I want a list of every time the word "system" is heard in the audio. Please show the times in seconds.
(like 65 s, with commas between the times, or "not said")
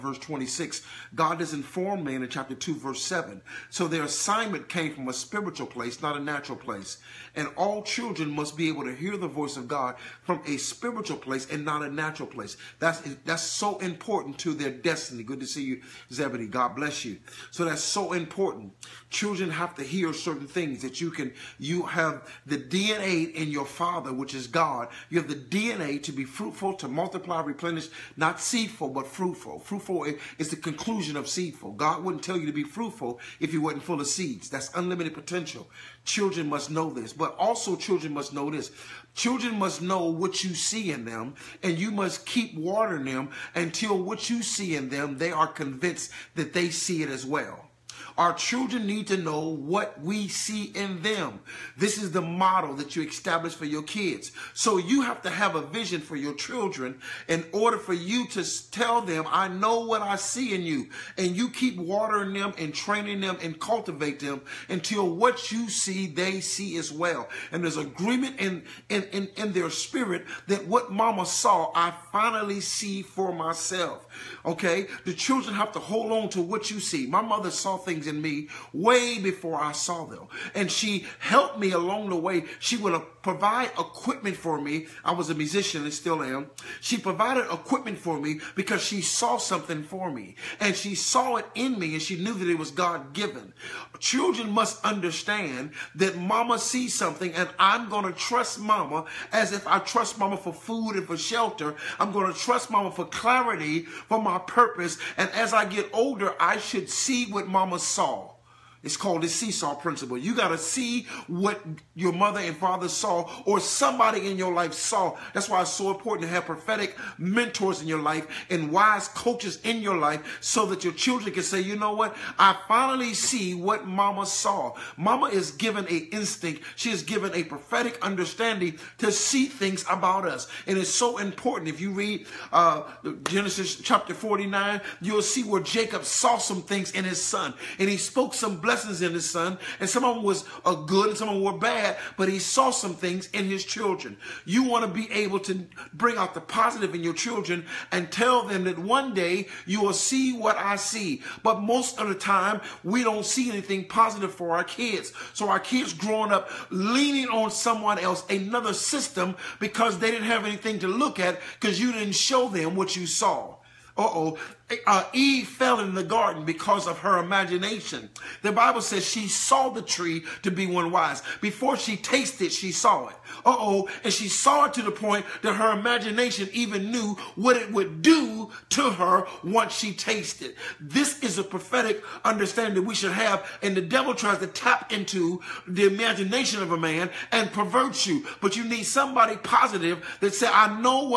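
158 s.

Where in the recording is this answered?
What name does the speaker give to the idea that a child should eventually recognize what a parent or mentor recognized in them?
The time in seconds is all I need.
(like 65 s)
109 s.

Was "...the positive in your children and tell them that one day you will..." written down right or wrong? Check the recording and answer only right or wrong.
right.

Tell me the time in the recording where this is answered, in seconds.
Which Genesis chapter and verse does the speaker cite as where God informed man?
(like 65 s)
2 s.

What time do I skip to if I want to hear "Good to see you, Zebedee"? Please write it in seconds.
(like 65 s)
15 s.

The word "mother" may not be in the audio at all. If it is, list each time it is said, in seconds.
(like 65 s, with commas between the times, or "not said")
77 s, 112 s.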